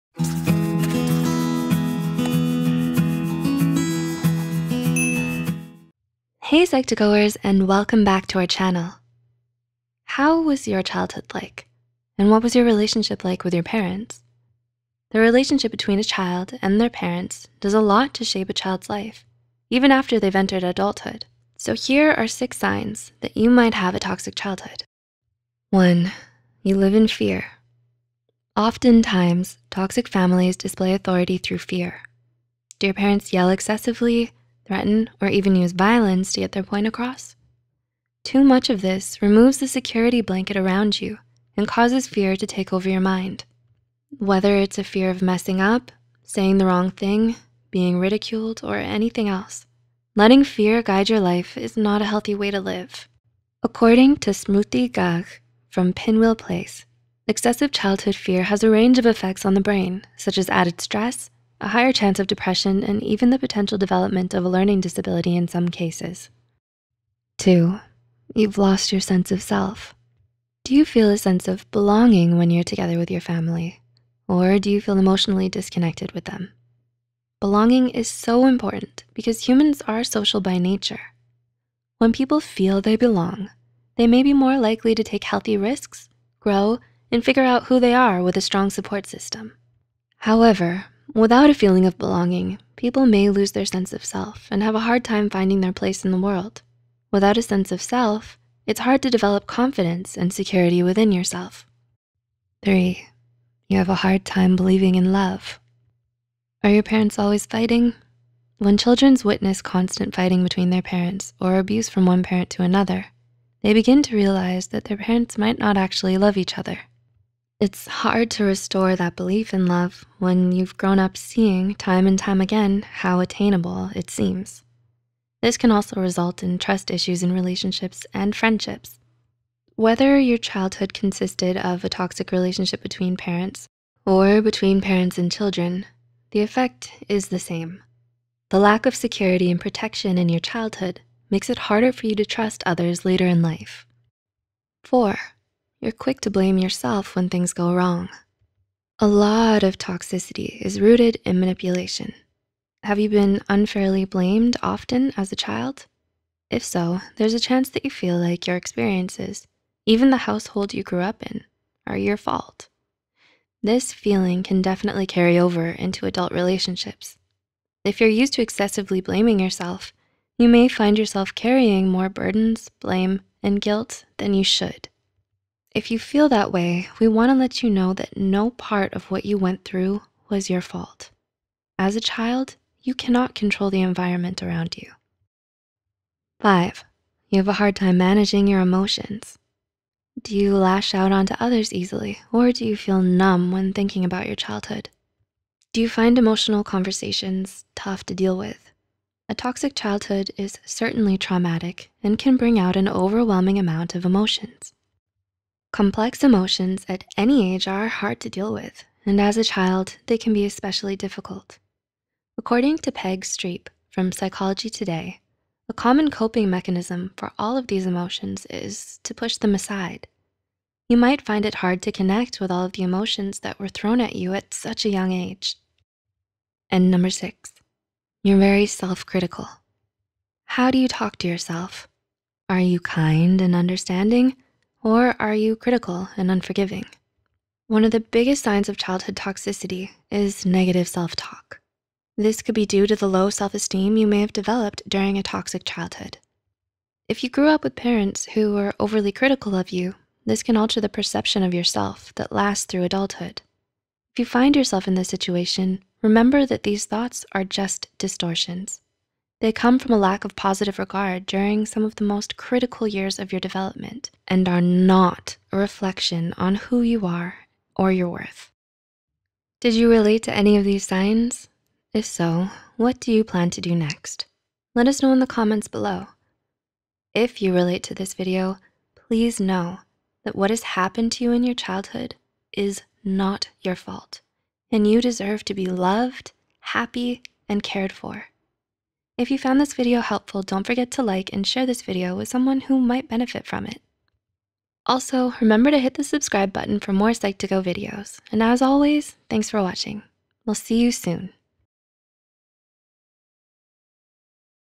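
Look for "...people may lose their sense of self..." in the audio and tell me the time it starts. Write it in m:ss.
1:32.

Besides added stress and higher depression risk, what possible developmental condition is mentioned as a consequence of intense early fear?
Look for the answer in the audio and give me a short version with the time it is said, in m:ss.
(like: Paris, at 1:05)
a learning disability, at 1:04.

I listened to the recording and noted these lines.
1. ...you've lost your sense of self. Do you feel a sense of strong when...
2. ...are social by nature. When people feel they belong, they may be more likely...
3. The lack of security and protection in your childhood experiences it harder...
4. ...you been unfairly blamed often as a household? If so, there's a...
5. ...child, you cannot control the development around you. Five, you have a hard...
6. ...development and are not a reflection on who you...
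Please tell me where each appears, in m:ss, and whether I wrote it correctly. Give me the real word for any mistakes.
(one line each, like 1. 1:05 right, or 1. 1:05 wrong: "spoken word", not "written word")
1. 1:08 wrong: "belonging", not "strong"
2. 1:19 right
3. 2:18 wrong: "makes", not "experiences"
4. 2:32 wrong: "child", not "household"
5. 3:02 wrong: "environment", not "development"
6. 4:23 right.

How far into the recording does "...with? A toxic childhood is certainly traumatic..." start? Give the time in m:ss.
3:18.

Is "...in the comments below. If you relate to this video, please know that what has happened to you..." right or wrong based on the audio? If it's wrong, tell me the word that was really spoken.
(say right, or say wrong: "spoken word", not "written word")
right.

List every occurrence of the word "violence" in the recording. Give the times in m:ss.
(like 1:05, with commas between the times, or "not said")
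0:35.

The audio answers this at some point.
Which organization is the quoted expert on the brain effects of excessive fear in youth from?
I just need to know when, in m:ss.
0:55.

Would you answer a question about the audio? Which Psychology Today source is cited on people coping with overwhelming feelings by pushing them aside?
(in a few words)
Peg Streep.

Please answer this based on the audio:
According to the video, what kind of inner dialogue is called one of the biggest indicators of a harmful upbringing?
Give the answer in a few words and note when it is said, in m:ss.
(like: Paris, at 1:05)
negative self-talk, at 4:00.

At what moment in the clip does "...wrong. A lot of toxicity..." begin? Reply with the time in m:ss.
2:27.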